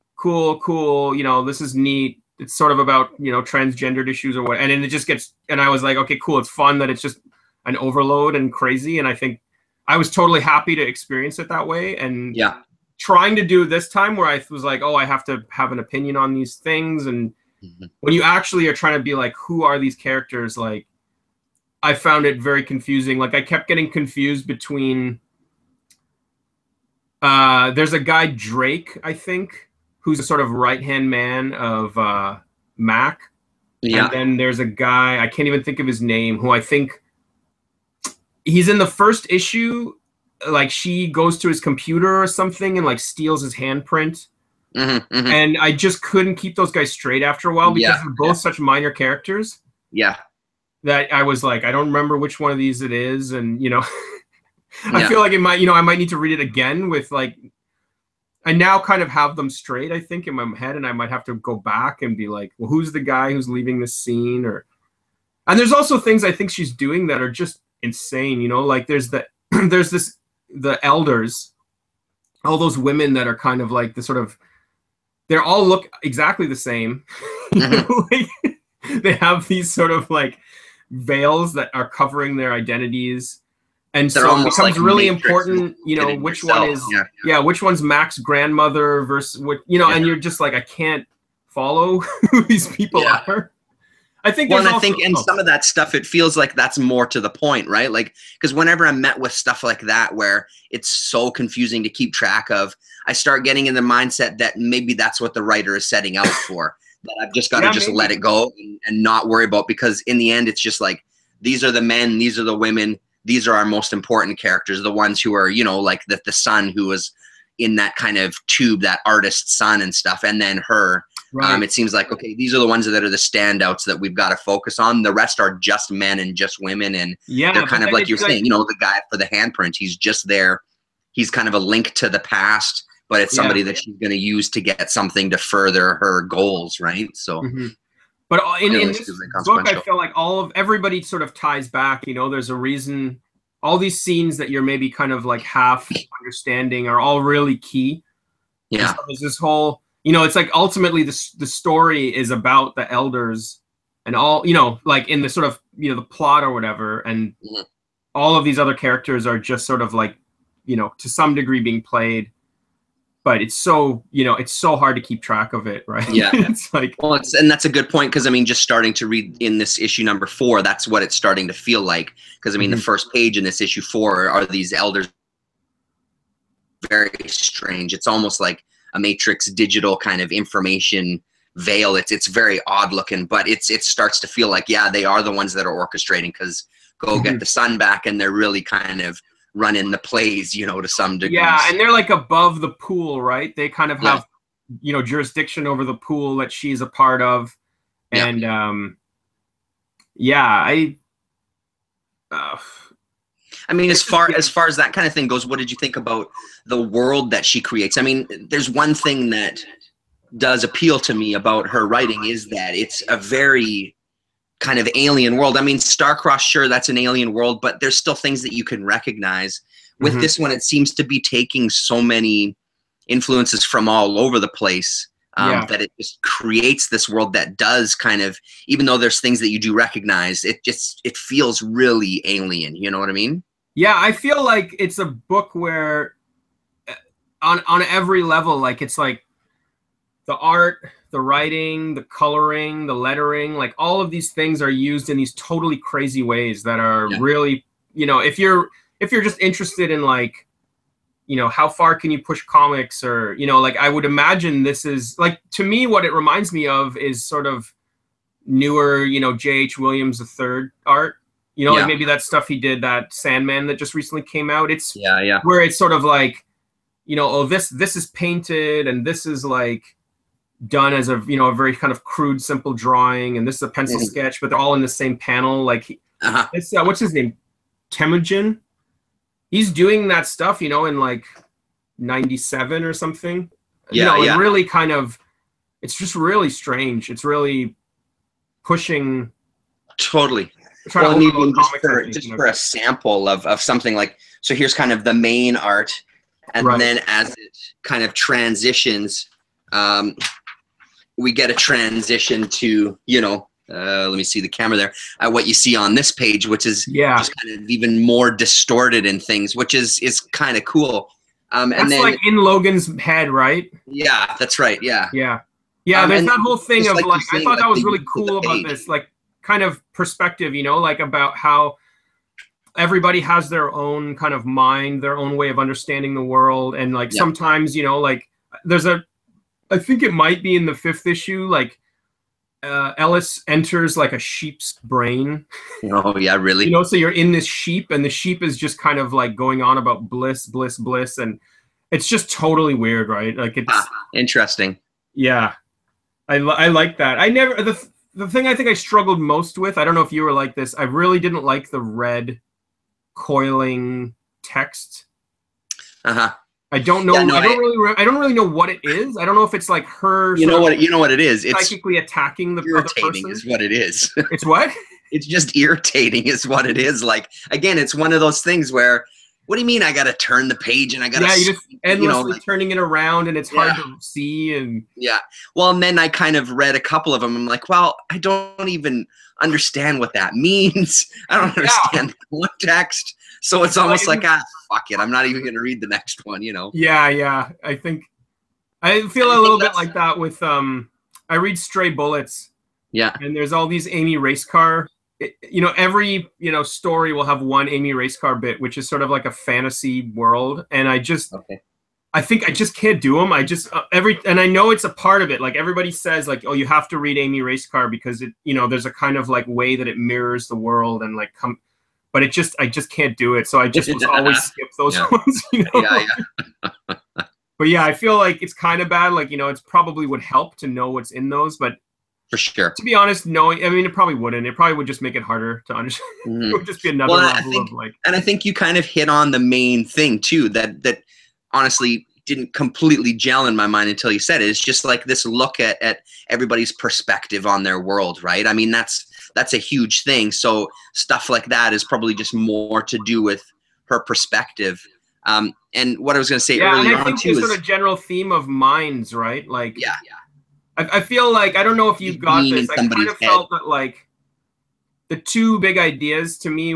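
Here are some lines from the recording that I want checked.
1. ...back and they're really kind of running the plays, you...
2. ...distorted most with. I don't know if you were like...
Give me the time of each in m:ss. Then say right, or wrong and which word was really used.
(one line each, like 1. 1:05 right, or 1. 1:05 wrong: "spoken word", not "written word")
1. 3:07 right
2. 5:48 wrong: "struggled", not "distorted".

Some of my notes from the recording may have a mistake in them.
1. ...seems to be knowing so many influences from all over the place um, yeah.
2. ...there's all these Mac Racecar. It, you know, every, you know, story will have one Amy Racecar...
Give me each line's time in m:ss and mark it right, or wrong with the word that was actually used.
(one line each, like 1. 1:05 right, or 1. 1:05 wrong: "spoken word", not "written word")
1. 3:40 wrong: "taking", not "knowing"
2. 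6:33 wrong: "Amy", not "Mac".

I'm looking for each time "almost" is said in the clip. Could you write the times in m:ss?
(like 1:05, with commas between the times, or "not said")
2:58, 6:23.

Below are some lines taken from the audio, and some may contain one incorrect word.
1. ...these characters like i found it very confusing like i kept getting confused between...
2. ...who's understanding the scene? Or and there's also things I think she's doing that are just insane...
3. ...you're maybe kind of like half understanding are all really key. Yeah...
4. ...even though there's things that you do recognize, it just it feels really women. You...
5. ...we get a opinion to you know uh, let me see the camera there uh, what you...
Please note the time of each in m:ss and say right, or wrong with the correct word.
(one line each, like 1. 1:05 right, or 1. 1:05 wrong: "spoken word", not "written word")
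1. 0:19 right
2. 1:03 wrong: "leaving", not "understanding"
3. 2:24 right
4. 3:48 wrong: "alien", not "women"
5. 5:01 wrong: "transition", not "opinion".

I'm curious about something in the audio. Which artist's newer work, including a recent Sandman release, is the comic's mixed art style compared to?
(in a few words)
J.H. Williams III.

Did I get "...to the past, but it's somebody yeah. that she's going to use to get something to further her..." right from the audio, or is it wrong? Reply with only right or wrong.
right.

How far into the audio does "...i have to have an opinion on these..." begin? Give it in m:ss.
0:14.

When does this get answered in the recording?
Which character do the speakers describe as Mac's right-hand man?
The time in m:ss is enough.
0:28.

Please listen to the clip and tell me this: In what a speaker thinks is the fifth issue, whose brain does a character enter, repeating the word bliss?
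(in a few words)
A sheep's.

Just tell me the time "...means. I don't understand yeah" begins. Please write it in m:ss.
6:20.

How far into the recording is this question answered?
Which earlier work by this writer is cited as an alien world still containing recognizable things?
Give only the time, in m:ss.
3:35.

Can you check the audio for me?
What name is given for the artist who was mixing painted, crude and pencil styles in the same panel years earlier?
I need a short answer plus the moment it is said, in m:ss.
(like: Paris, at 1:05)
Temujin, at 4:37.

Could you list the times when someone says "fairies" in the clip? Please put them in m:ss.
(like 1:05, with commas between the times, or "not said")
not said.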